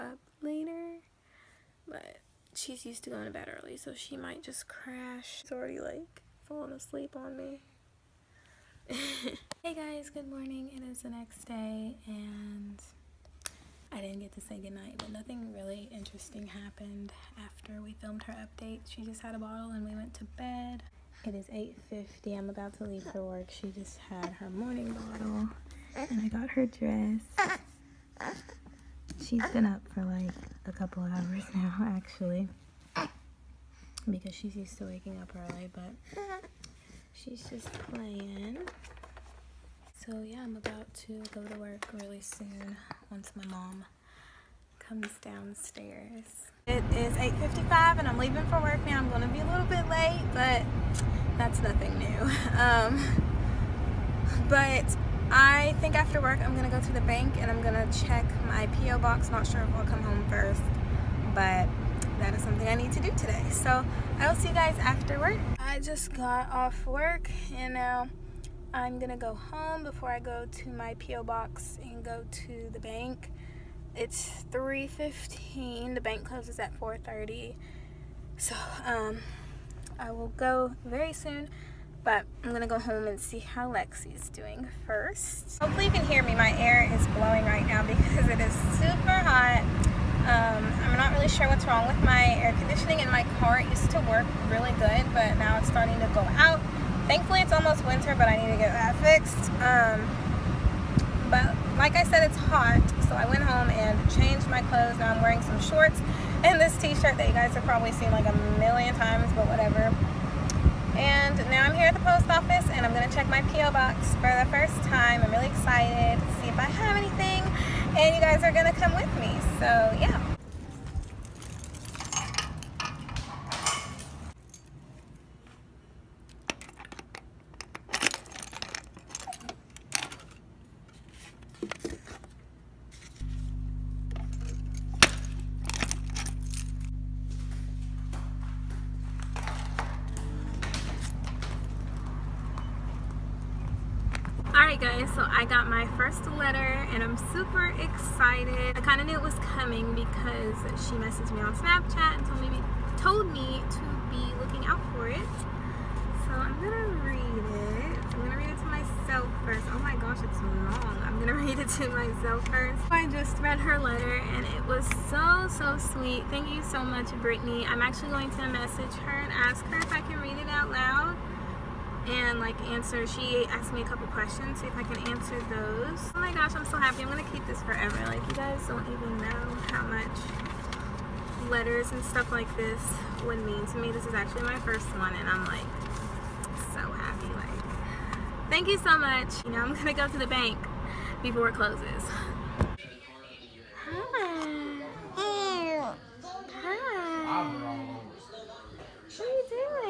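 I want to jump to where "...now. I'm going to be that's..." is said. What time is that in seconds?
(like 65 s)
48 s.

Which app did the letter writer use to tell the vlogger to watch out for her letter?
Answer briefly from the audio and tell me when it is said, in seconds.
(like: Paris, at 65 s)
Snapchat, at 151 s.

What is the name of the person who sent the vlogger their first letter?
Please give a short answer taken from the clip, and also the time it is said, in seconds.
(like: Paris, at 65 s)
Brittany, at 167 s.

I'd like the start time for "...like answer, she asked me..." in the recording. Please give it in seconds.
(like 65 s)
172 s.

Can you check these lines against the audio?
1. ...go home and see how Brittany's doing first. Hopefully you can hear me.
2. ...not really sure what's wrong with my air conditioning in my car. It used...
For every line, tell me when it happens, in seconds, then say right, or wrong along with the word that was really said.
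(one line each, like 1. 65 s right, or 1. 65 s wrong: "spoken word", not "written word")
1. 82 s wrong: "Lexi", not "Brittany"
2. 90 s right.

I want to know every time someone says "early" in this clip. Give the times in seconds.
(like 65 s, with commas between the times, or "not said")
3 s, 35 s.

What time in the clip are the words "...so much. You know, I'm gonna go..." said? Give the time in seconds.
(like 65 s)
188 s.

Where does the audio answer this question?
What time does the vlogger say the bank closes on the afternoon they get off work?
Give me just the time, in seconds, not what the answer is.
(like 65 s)
76 s.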